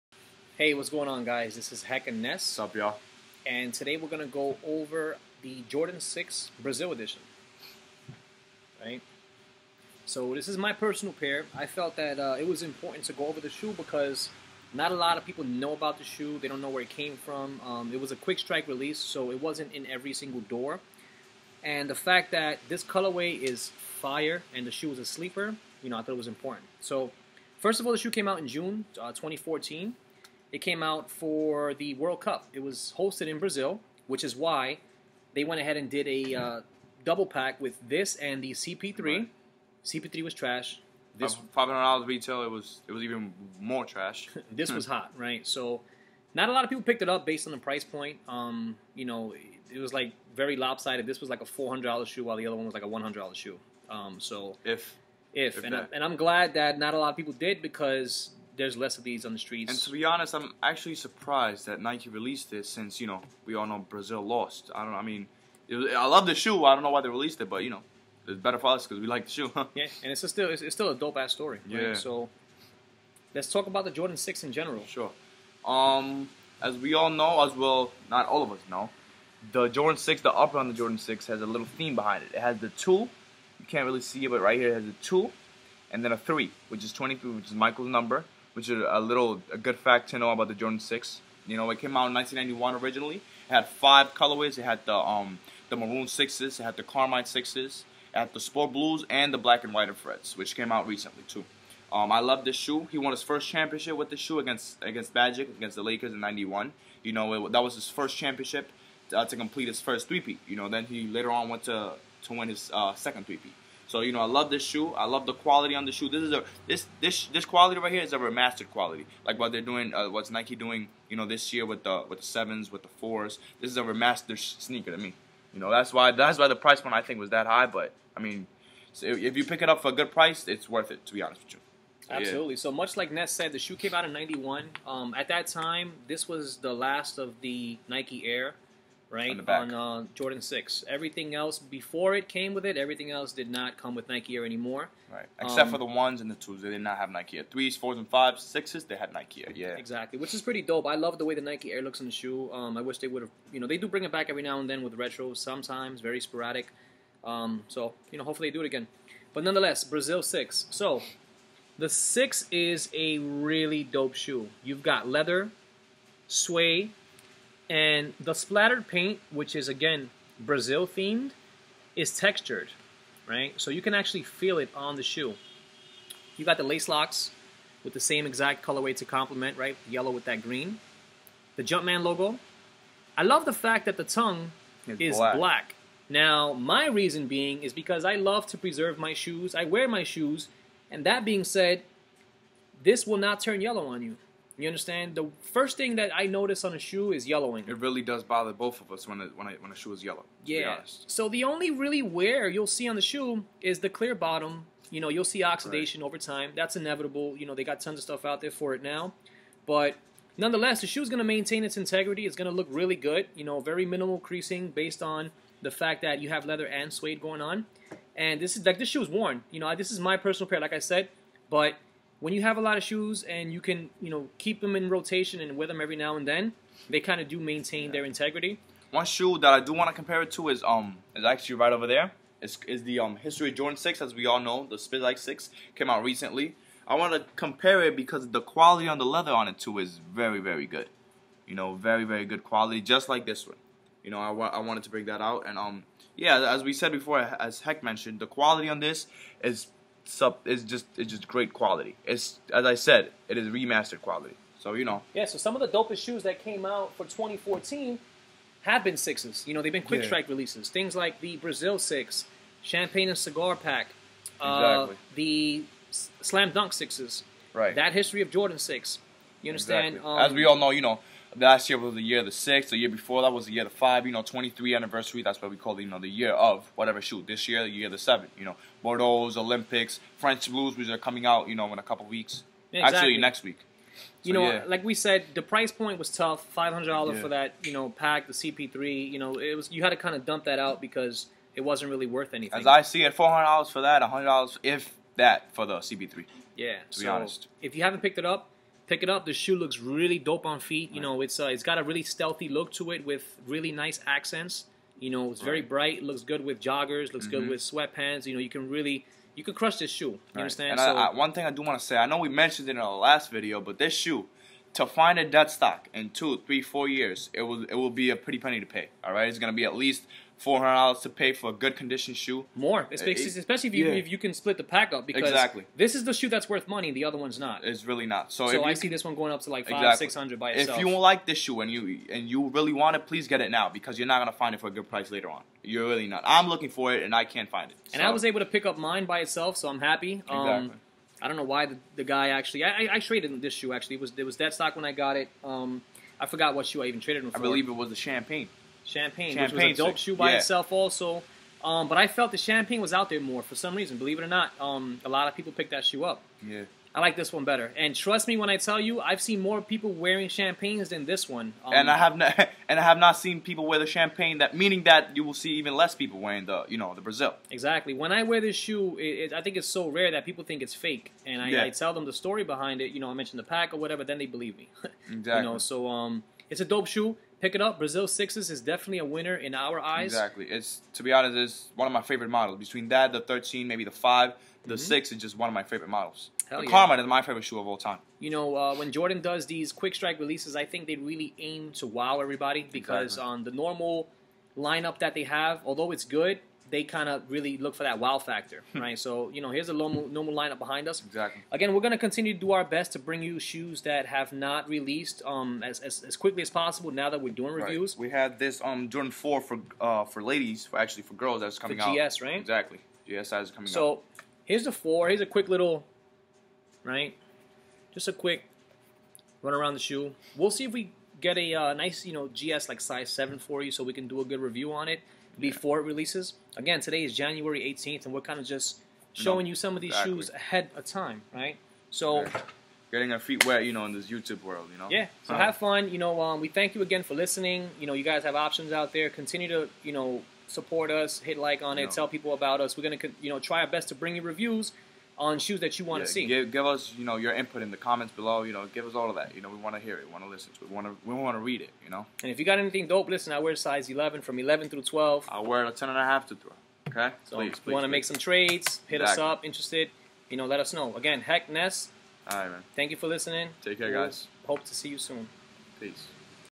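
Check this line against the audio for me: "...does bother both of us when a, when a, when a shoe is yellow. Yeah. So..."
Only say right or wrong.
right.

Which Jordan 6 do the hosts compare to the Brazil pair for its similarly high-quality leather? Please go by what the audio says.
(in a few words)
History Jordan Six.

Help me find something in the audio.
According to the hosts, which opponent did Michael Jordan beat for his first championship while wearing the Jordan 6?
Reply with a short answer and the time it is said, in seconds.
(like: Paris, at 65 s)
the Lakers, at 105 s.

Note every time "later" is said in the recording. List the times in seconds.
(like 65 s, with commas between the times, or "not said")
111 s, 335 s.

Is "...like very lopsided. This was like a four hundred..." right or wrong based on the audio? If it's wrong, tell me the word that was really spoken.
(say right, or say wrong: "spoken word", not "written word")
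right.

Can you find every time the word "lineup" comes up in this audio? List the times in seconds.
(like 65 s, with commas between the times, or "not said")
394 s, 400 s.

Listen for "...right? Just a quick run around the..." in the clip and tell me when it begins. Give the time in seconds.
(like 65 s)
416 s.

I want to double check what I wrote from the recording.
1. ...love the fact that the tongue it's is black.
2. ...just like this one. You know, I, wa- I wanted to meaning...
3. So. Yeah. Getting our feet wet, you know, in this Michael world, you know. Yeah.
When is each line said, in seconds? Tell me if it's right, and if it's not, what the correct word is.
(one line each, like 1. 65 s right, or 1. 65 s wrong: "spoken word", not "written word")
1. 183 s right
2. 242 s wrong: "bring", not "meaning"
3. 431 s wrong: "YouTube", not "Michael".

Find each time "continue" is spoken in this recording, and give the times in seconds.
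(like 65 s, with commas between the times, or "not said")
401 s, 439 s.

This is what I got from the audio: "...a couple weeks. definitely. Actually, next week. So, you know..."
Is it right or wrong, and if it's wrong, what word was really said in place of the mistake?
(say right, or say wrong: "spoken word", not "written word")
wrong: "exactly", not "definitely".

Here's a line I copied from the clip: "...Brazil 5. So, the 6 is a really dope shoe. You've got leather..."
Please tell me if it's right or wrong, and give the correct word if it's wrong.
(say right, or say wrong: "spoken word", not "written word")
wrong: "6", not "5".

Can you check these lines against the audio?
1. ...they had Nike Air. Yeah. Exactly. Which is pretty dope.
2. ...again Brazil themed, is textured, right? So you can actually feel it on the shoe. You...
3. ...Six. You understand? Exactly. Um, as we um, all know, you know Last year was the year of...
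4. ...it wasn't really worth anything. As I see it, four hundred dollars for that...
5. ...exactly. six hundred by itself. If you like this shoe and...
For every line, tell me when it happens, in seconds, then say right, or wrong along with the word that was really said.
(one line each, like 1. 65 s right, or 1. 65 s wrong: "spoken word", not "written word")
1. 148 s right
2. 169 s right
3. 268 s right
4. 291 s right
5. 329 s right.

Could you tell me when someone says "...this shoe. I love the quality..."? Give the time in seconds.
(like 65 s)
114 s.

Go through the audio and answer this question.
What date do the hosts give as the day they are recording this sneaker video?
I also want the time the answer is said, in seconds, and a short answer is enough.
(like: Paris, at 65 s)
January 18th, at 427 s.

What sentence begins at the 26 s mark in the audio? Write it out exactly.
So, first of all, the shoe came out in June uh, 2014.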